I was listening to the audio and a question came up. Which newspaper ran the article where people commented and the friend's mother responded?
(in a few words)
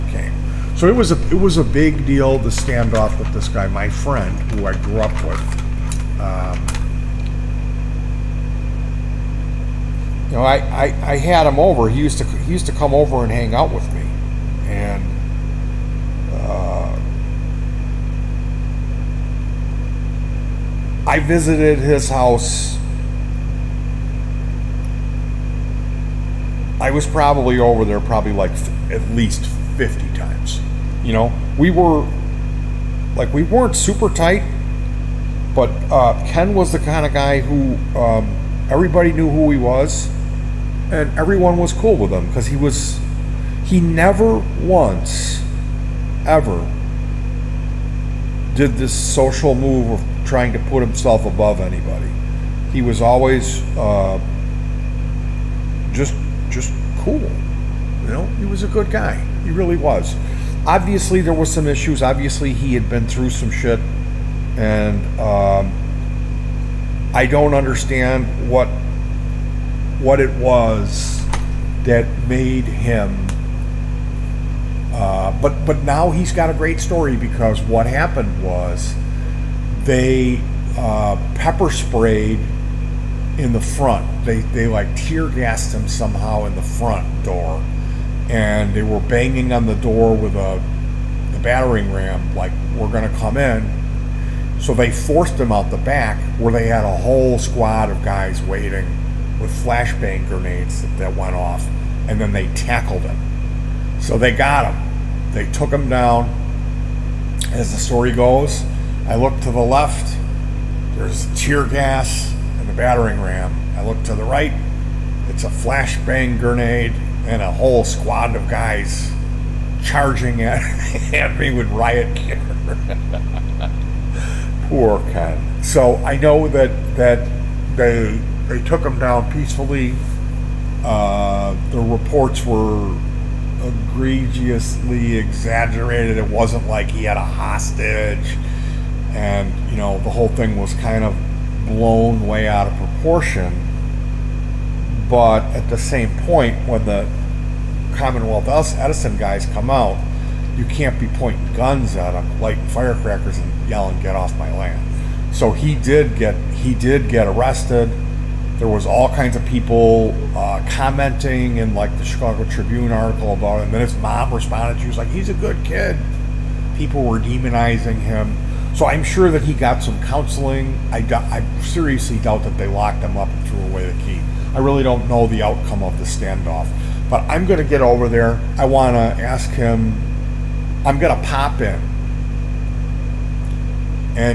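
Chicago Tribune.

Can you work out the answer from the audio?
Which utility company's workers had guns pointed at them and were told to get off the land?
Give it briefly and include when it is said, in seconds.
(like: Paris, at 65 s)
Commonwealth Edison, at 147 s.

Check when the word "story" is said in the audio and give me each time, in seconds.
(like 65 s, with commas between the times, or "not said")
76 s, 107 s.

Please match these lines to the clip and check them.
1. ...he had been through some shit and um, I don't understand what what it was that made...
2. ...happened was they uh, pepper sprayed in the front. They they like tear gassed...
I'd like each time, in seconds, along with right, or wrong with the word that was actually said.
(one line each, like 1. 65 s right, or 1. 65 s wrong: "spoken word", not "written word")
1. 62 s right
2. 77 s right.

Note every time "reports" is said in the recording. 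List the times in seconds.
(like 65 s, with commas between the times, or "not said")
131 s.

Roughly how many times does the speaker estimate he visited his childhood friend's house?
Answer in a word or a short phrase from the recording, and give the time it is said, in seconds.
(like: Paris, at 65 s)
50, at 29 s.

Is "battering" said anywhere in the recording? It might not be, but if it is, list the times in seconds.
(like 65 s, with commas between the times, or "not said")
91 s, 112 s.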